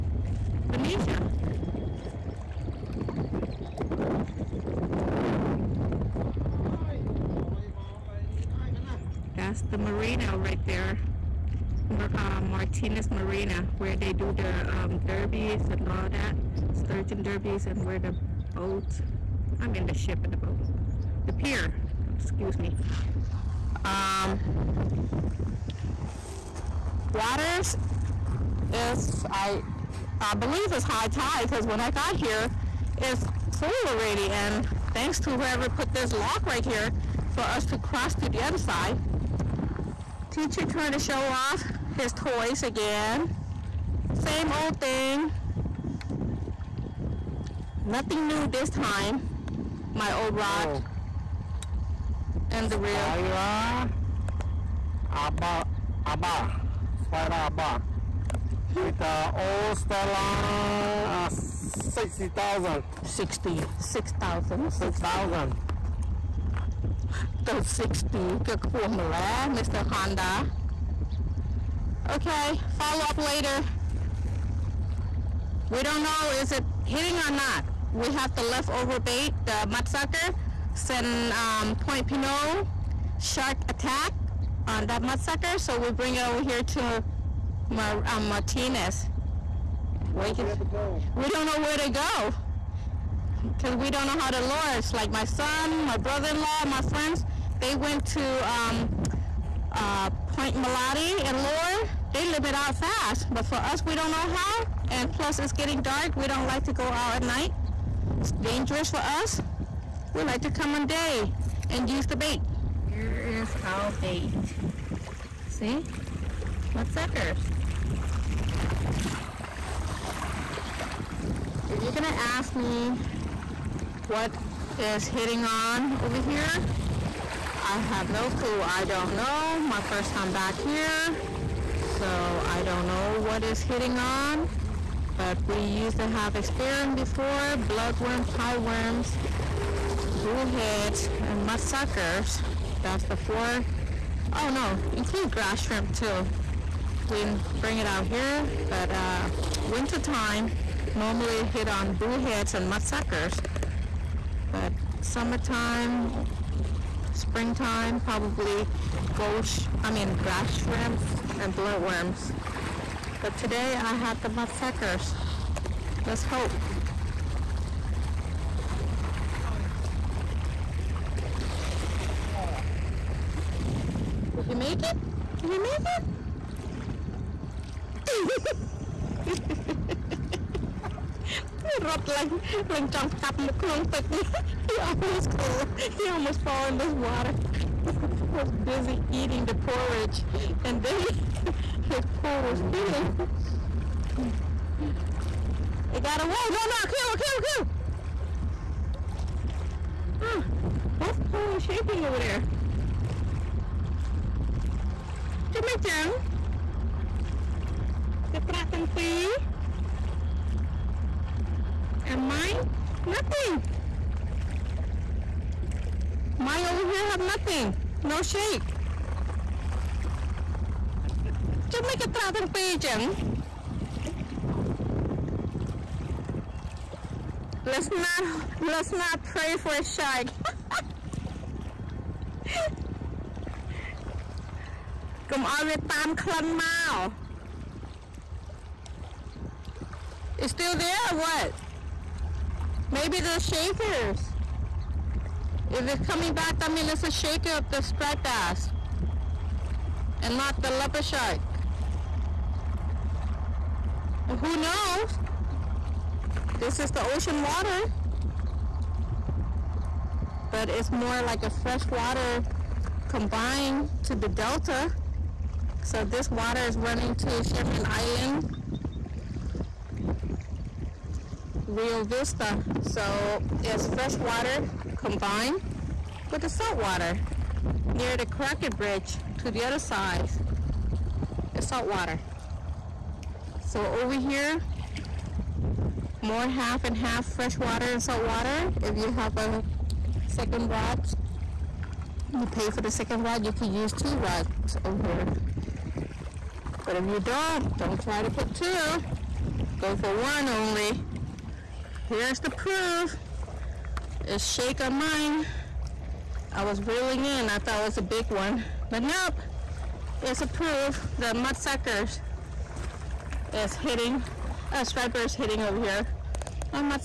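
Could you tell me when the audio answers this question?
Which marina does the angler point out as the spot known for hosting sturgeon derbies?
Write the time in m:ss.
0:12.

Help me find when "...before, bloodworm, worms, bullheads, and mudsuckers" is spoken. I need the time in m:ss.
2:16.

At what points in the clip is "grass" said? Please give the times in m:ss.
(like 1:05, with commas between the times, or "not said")
2:25, 2:40.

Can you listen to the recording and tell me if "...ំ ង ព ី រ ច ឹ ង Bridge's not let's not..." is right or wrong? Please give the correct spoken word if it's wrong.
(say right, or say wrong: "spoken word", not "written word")
wrong: "Let", not "Bridge".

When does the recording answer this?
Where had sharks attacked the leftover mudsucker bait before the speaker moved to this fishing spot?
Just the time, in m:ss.
1:21.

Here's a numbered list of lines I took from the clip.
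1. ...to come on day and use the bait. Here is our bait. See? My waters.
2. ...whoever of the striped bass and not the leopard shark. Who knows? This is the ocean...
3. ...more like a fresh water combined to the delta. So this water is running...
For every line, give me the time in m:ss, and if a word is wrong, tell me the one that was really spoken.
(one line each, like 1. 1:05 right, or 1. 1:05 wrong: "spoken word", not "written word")
1. 1:50 wrong: "suckers", not "waters"
2. 4:07 wrong: "shaker", not "whoever"
3. 4:20 right.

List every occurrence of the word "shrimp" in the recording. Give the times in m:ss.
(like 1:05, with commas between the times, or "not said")
2:25, 2:40.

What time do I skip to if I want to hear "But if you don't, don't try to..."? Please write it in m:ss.
4:56.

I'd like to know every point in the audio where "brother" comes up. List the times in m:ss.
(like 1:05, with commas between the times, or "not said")
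1:35.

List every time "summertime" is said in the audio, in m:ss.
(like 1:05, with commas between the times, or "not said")
2:35.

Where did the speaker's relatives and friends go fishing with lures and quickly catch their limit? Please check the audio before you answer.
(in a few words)
Point Molate.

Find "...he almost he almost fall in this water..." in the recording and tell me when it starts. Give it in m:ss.
3:04.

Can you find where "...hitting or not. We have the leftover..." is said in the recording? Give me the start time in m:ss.
1:16.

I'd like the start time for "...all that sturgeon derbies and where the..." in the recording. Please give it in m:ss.
0:15.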